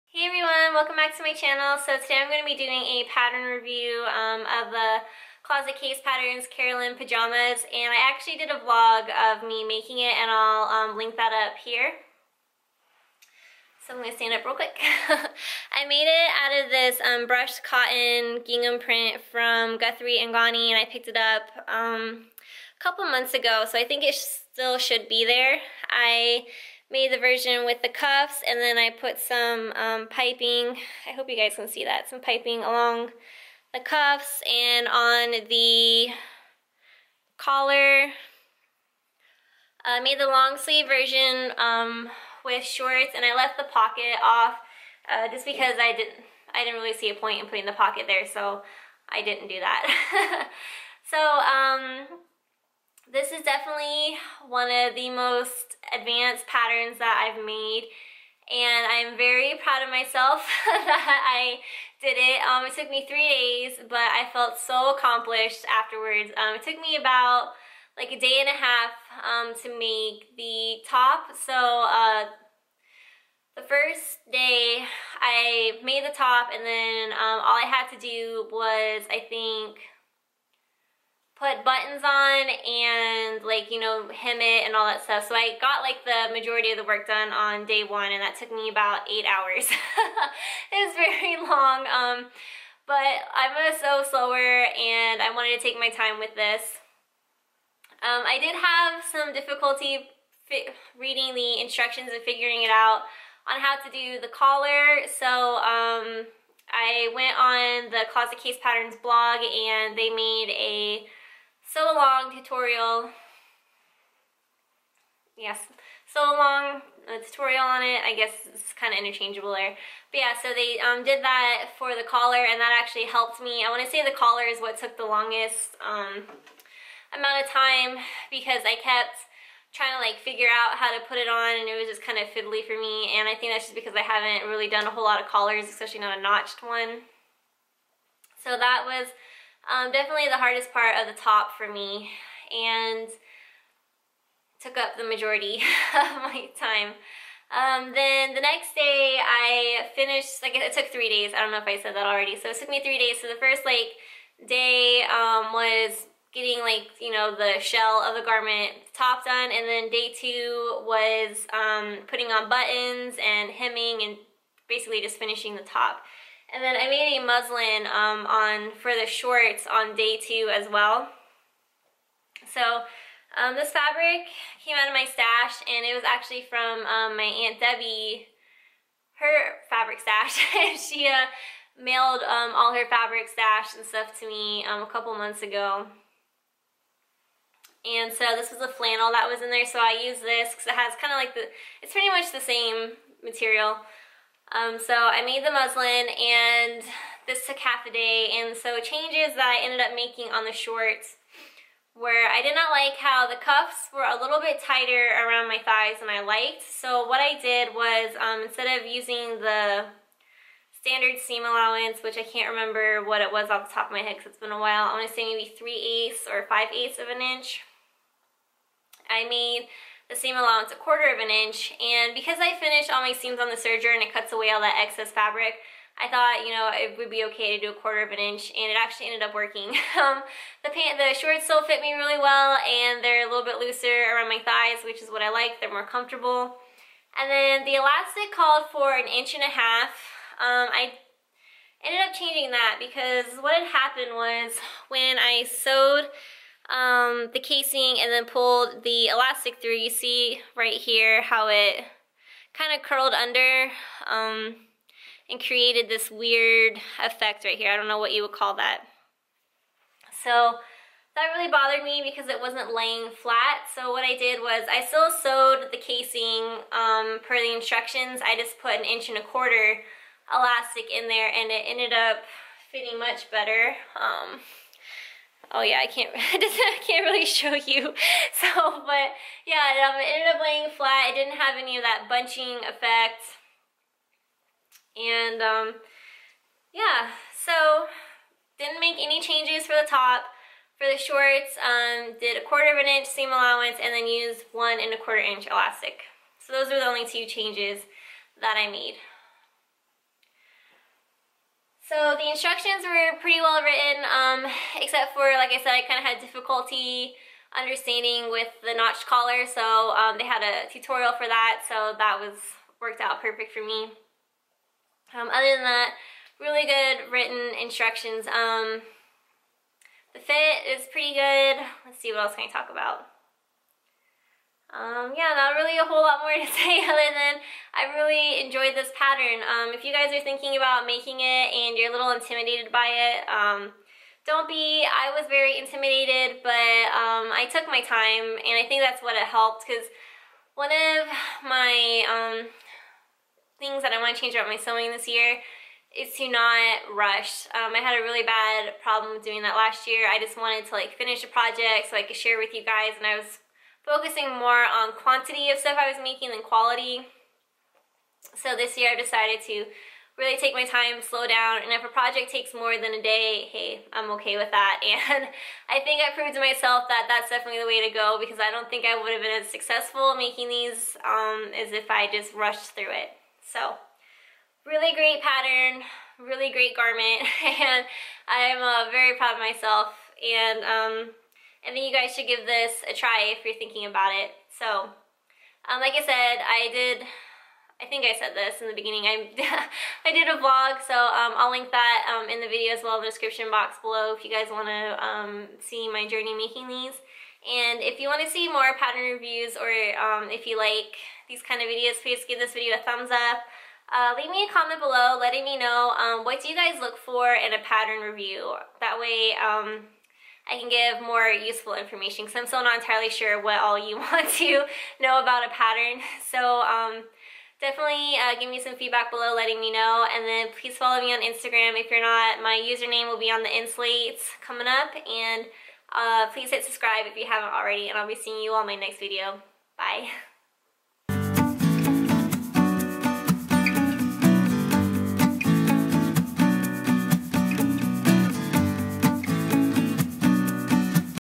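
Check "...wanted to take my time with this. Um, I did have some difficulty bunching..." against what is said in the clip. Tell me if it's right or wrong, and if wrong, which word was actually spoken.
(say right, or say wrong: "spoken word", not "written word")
wrong: "reading", not "bunching".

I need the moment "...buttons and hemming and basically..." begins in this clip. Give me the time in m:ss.
2:42.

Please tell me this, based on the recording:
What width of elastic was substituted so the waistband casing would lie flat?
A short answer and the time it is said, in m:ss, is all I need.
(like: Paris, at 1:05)
1 1/4 inches, at 4:28.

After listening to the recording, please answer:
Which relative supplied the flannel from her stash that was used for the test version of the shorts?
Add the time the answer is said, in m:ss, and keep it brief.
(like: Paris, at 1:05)
Aunt Debbie, at 2:57.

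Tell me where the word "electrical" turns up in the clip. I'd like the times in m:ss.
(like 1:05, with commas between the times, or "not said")
not said.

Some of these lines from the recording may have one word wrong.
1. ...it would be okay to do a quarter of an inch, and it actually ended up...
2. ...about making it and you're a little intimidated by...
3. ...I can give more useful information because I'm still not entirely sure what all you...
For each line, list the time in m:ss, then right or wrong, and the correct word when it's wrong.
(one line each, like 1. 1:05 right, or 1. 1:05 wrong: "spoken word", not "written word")
1. 3:46 right
2. 5:30 right
3. 6:50 right.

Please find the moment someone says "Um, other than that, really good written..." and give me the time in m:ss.
5:15.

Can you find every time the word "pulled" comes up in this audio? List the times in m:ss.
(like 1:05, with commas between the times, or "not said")
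4:08.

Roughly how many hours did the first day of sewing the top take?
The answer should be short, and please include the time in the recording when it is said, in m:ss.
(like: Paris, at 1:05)
8 hours, at 1:29.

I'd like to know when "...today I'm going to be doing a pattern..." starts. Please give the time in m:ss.
0:02.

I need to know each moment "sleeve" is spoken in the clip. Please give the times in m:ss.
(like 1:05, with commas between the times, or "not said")
0:40.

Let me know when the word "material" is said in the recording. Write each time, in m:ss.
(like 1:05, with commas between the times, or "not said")
3:13.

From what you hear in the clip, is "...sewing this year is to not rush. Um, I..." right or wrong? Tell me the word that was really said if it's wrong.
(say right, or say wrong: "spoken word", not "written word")
right.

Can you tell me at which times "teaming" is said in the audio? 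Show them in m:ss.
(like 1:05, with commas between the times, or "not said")
not said.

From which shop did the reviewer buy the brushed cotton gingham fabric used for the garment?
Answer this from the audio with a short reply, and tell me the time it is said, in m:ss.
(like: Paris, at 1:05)
Guthrie and Ghani, at 0:19.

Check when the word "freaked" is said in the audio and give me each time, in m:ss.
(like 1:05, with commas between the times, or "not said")
not said.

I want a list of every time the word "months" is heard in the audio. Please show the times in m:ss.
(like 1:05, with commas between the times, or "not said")
0:23, 3:05.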